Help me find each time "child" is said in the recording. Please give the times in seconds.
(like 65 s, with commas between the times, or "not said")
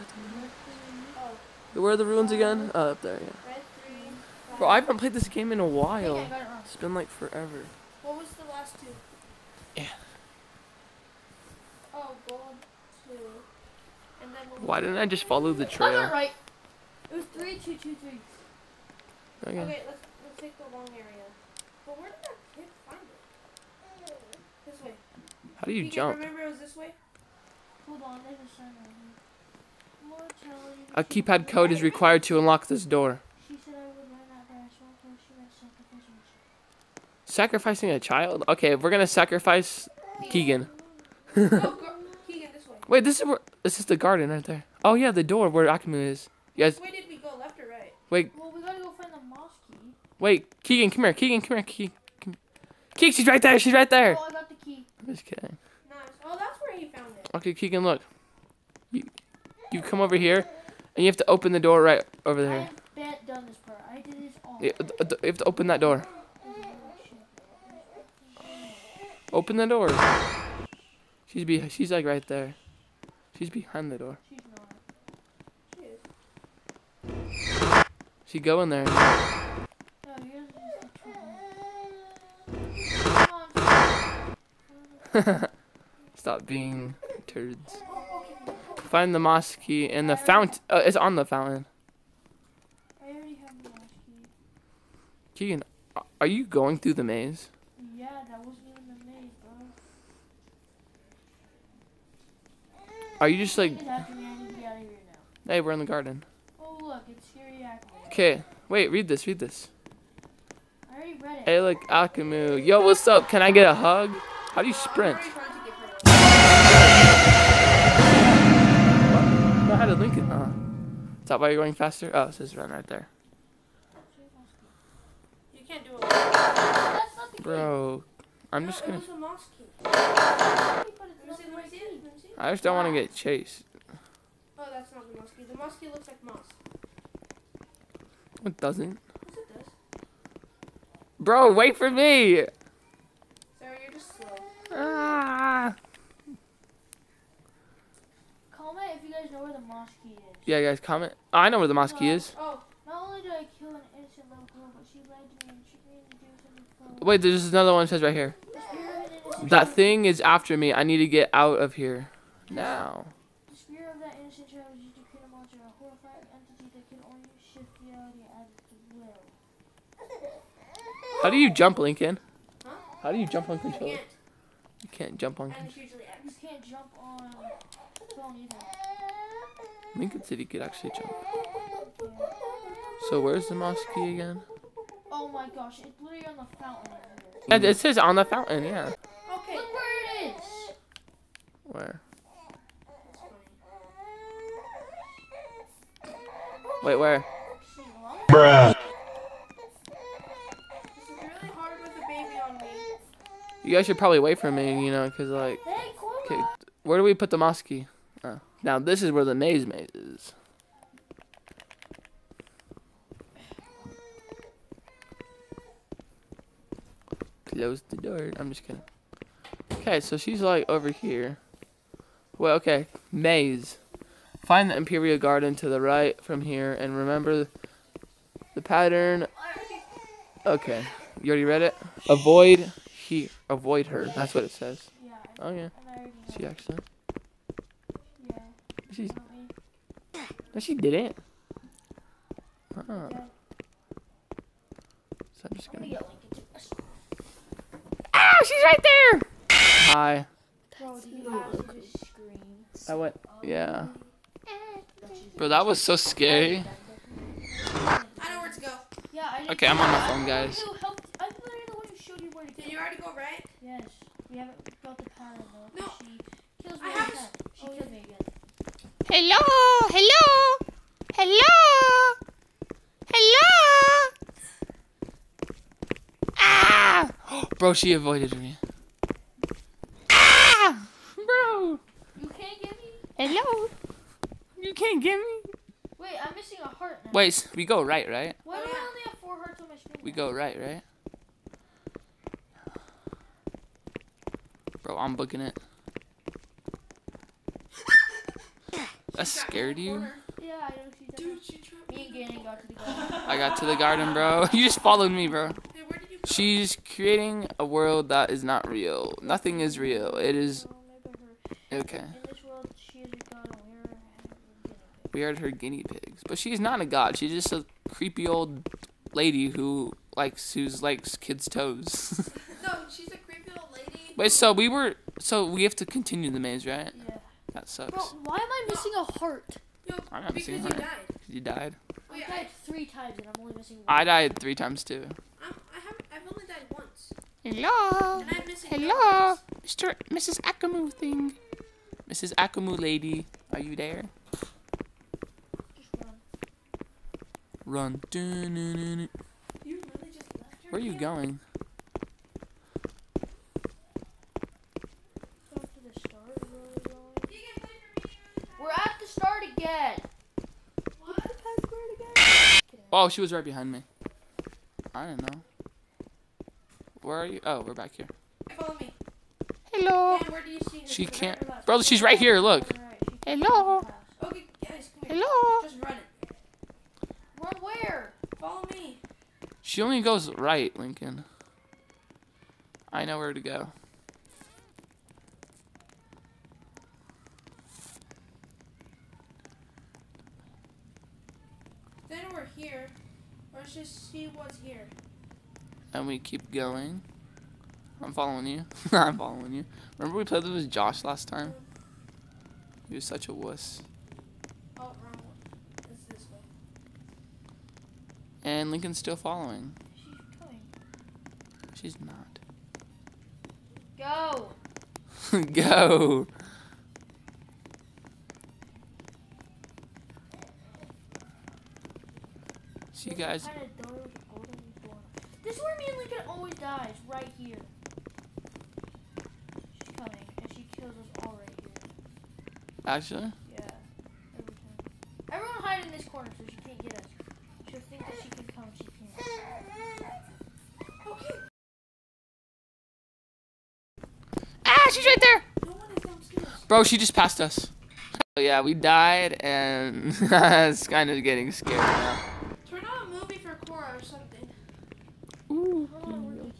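37 s, 164 s.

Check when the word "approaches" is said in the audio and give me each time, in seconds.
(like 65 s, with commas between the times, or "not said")
not said.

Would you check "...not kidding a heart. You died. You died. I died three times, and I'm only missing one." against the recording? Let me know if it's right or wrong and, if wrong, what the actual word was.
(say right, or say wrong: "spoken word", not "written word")
wrong: "missing", not "kidding".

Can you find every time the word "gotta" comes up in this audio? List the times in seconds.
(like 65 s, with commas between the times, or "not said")
48 s.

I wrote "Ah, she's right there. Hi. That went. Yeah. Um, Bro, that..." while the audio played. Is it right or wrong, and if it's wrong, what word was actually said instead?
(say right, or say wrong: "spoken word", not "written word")
right.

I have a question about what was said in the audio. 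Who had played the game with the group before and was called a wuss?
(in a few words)
Josh.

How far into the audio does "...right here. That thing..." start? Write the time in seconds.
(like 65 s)
158 s.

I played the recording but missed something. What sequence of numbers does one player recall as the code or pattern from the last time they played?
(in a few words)
3, 2, 2, 3.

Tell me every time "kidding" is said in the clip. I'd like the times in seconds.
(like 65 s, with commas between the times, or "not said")
55 s, 218 s.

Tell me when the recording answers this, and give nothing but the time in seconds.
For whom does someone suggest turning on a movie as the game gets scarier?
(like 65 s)
453 s.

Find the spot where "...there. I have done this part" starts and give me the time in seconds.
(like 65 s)
62 s.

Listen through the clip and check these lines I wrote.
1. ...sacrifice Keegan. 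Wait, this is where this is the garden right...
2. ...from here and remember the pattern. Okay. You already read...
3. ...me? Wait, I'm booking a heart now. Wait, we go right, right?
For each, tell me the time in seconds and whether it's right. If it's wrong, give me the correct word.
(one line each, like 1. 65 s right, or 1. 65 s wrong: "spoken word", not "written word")
1. 39 s right
2. 226 s right
3. 285 s wrong: "missing", not "booking".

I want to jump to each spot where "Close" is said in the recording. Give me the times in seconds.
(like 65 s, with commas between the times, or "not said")
217 s.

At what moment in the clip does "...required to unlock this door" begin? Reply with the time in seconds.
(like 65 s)
31 s.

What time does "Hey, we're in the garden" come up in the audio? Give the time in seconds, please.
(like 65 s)
105 s.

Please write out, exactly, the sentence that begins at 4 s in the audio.
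Bro, I haven't played this game in a while.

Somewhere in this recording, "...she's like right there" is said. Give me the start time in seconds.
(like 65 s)
71 s.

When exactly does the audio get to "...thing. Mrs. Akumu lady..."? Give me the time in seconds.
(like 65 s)
340 s.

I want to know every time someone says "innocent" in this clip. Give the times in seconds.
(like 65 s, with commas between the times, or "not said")
153 s, 164 s.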